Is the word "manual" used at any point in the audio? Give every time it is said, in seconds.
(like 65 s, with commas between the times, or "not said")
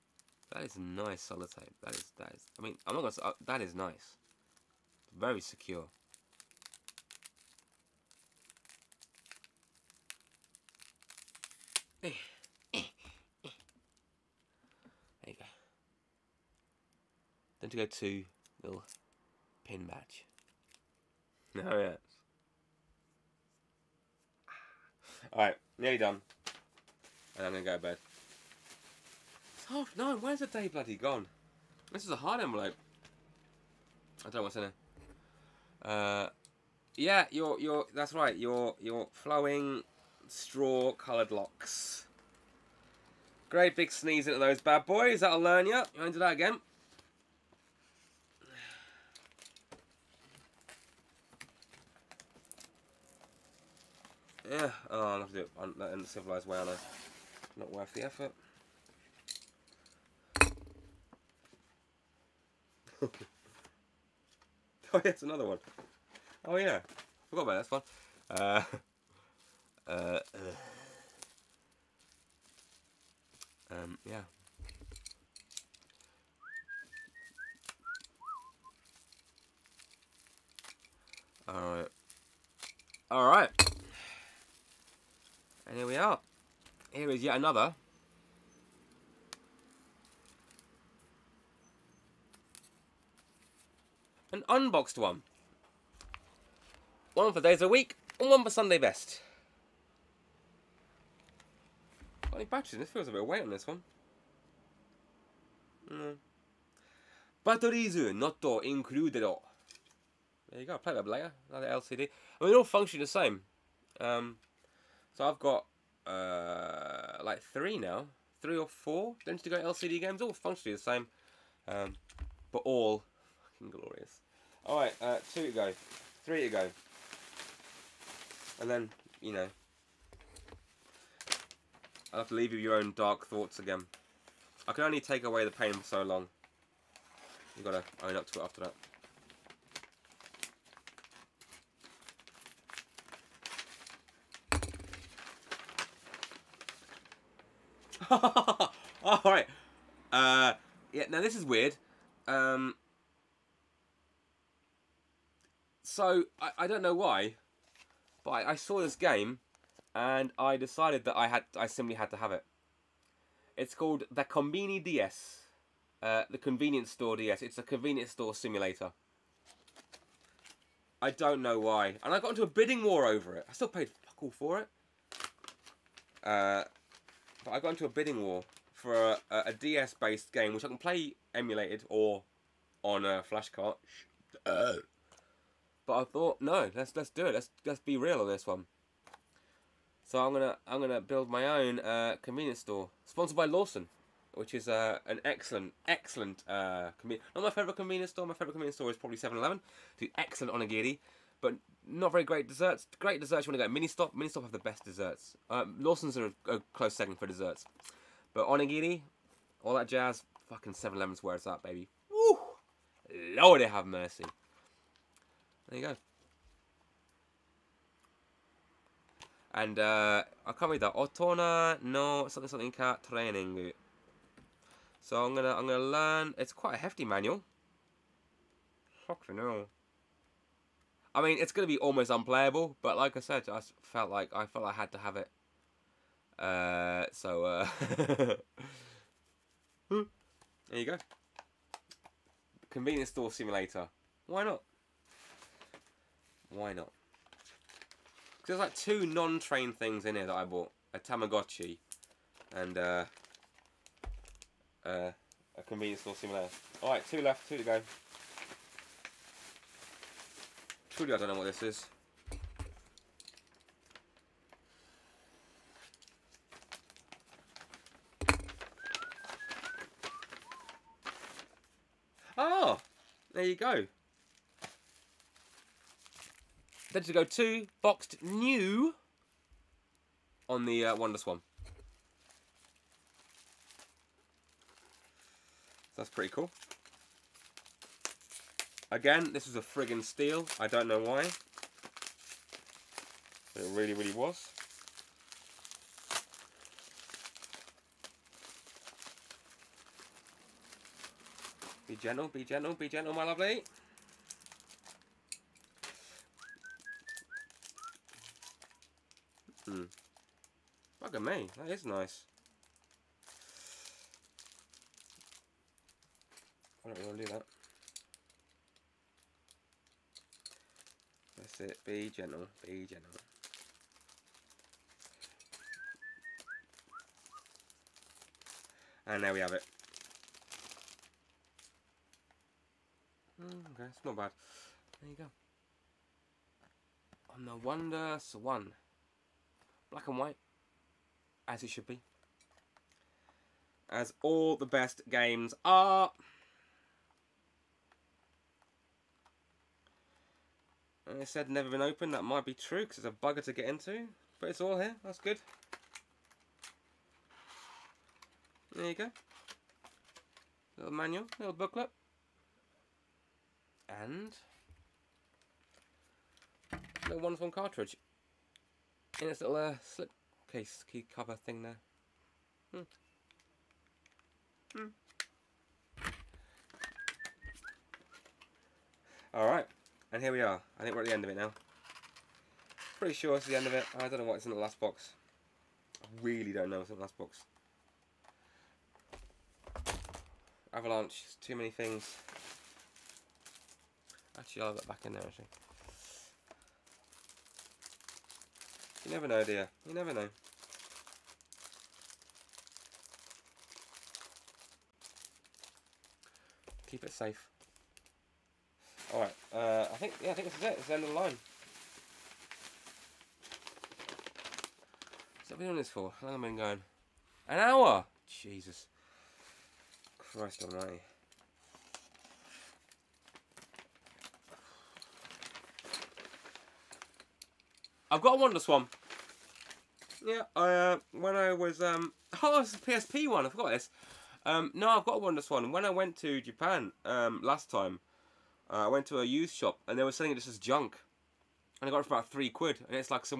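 227 s, 360 s.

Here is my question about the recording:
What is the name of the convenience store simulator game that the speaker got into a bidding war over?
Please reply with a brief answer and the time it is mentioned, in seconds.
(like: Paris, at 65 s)
Combini DS, at 164 s.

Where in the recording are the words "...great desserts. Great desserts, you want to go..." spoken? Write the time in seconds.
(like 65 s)
202 s.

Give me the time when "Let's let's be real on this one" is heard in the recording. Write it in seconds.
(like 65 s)
187 s.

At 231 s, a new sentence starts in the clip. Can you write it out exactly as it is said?
I mean, it's going to be almost unplayable, but like I said, I felt like I felt I had to have it.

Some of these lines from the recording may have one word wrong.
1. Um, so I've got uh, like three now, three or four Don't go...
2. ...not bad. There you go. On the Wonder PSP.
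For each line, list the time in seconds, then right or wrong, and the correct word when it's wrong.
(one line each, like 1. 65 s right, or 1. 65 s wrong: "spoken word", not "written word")
1. 113 s right
2. 334 s wrong: "Swan", not "PSP".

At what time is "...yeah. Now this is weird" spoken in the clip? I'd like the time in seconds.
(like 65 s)
150 s.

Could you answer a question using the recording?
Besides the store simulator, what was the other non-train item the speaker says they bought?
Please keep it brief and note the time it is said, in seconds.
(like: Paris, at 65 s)
A Tamagotchi, at 250 s.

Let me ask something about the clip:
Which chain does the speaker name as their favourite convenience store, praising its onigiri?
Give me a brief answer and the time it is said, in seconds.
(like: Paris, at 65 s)
7-Eleven, at 199 s.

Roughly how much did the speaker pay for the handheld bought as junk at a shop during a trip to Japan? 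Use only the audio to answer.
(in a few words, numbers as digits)
About 3 quid.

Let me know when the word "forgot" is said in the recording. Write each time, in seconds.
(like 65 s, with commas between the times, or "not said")
67 s, 433 s.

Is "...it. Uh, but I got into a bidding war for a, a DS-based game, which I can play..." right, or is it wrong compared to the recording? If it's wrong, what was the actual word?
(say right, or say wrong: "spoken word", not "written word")
right.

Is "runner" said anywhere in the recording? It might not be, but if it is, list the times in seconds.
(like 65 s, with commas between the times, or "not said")
not said.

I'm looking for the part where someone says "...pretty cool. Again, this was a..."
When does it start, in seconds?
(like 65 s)
286 s.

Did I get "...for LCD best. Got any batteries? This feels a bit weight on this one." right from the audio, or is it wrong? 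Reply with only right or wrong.
wrong.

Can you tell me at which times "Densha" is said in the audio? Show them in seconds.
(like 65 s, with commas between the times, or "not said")
17 s, 276 s.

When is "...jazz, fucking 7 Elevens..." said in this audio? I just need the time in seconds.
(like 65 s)
209 s.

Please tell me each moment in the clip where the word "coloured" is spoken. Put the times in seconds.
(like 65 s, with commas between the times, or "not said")
40 s.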